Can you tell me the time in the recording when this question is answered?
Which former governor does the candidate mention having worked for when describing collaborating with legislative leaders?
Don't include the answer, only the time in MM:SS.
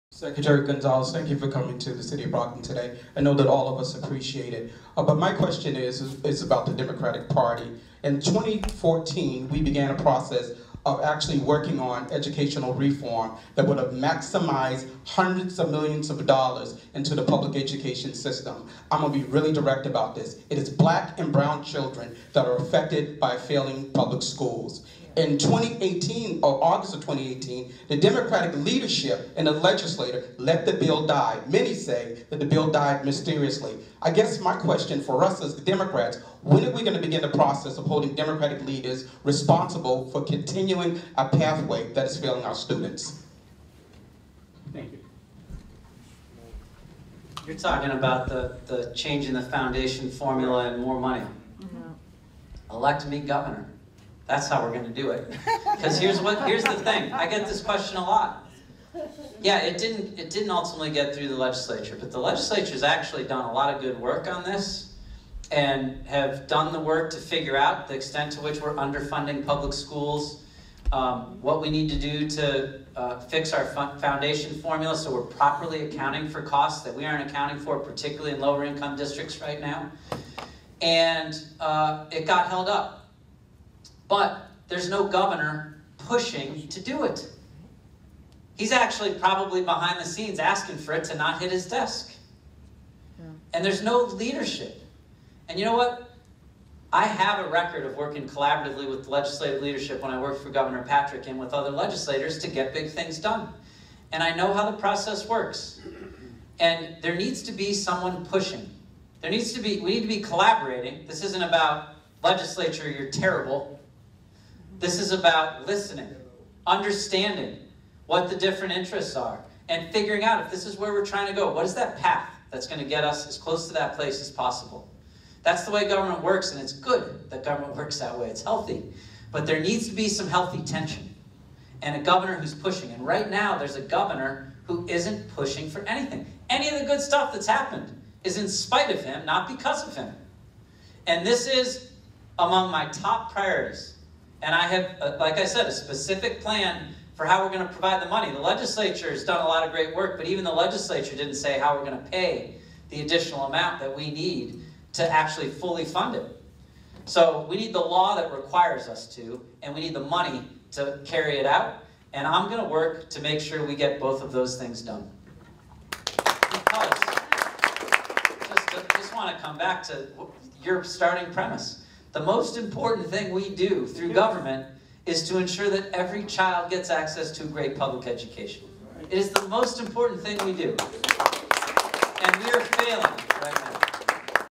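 01:40.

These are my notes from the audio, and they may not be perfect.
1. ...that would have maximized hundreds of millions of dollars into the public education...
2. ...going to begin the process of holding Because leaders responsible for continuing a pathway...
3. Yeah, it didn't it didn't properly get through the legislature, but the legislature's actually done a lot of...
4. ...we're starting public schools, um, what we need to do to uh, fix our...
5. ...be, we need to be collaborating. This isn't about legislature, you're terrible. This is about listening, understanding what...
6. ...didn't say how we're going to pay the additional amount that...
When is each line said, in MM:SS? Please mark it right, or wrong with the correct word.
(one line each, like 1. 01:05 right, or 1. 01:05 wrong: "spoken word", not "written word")
1. 00:13 right
2. 00:36 wrong: "Democratic", not "Because"
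3. 00:59 wrong: "ultimately", not "properly"
4. 01:08 wrong: "underfunding", not "starting"
5. 01:49 right
6. 02:31 right.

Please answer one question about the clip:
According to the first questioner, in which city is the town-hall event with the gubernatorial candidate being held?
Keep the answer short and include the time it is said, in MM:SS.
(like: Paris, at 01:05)
Brockton, at 00:02.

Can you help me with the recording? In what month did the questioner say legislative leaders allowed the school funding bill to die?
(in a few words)
August.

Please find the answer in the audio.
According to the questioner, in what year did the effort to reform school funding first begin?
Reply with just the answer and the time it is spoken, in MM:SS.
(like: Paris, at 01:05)
2014, at 00:08.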